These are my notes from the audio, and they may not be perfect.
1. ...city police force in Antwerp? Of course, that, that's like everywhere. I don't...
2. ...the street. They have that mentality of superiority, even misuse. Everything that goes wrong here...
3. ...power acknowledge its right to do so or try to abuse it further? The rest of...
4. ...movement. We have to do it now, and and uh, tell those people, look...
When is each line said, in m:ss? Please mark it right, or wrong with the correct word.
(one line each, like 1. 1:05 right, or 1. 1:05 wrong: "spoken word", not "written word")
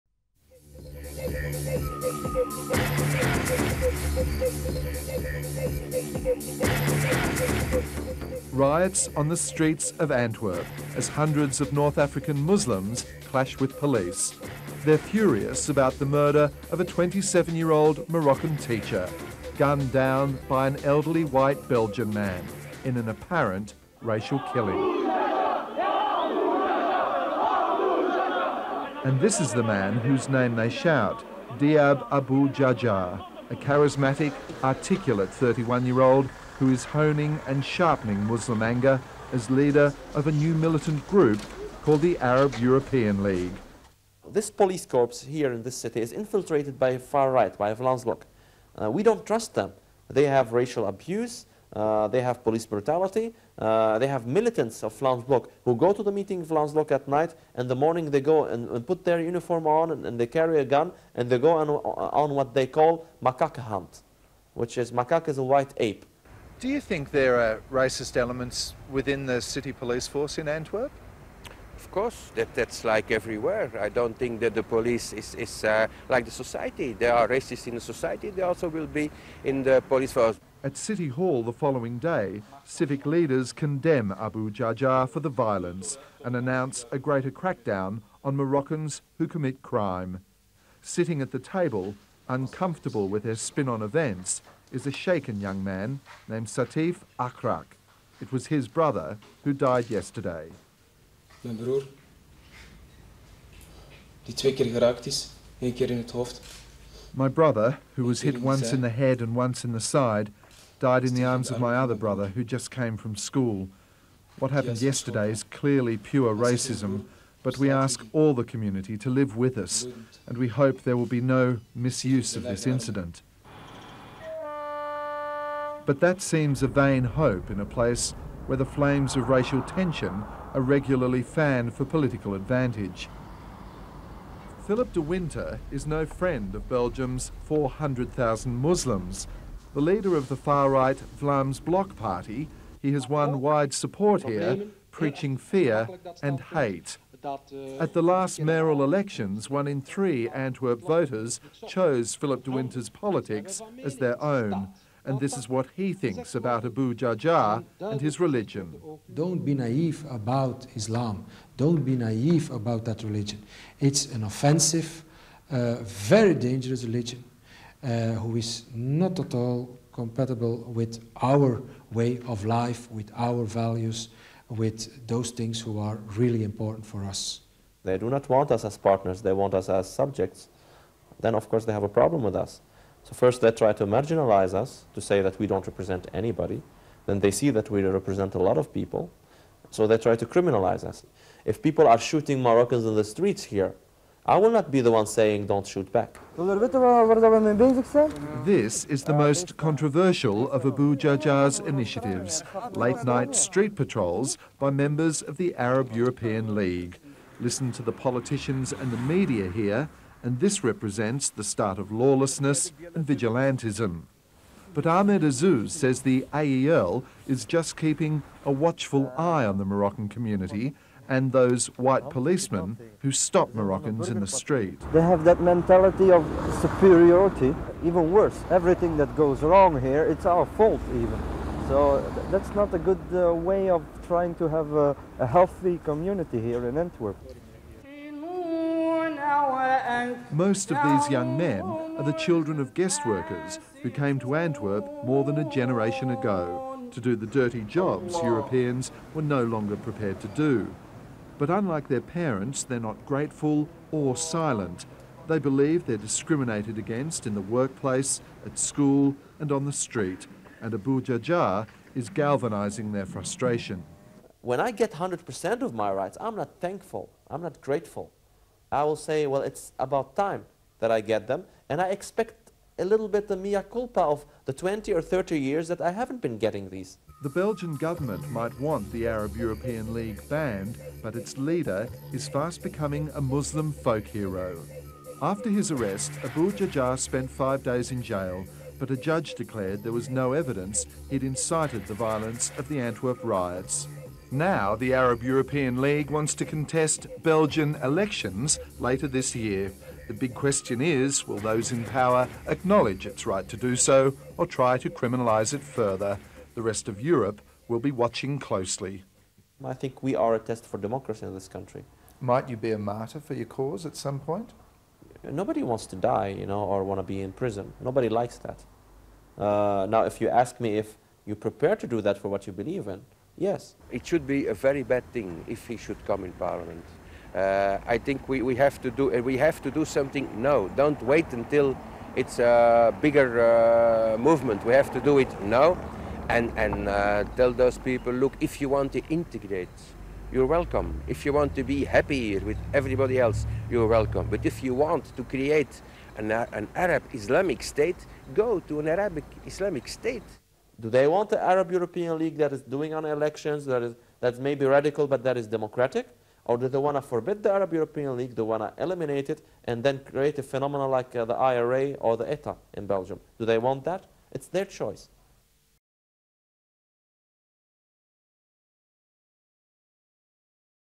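1. 1:09 right
2. 3:44 wrong: "worse", not "misuse"
3. 5:01 wrong: "criminalise", not "abuse"
4. 5:34 right.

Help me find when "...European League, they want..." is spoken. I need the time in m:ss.
5:57.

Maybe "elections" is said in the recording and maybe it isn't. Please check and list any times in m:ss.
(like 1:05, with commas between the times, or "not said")
2:28, 4:57, 5:53.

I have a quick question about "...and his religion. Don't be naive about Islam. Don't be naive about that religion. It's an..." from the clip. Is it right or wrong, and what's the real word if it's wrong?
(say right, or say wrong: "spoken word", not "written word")
right.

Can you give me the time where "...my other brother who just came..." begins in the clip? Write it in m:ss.
1:51.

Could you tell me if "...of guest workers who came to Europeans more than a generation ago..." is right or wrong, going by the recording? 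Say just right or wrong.
wrong.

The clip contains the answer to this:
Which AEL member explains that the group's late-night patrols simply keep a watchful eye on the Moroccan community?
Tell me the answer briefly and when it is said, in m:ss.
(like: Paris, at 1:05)
Ahmed Azouz, at 3:34.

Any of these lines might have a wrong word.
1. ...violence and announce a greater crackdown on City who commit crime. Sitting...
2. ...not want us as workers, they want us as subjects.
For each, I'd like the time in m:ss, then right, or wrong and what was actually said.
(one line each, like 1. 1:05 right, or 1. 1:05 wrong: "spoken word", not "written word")
1. 1:25 wrong: "Moroccans", not "City"
2. 2:58 wrong: "partners", not "workers".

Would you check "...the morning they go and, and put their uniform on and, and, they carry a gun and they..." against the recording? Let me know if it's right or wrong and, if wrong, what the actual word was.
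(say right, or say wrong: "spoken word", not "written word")
right.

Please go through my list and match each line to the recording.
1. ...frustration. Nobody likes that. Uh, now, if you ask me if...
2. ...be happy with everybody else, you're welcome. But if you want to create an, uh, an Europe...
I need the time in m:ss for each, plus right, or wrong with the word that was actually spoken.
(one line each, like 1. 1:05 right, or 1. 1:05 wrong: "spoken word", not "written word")
1. 5:17 wrong: "prison", not "frustration"
2. 5:41 wrong: "Arab", not "Europe".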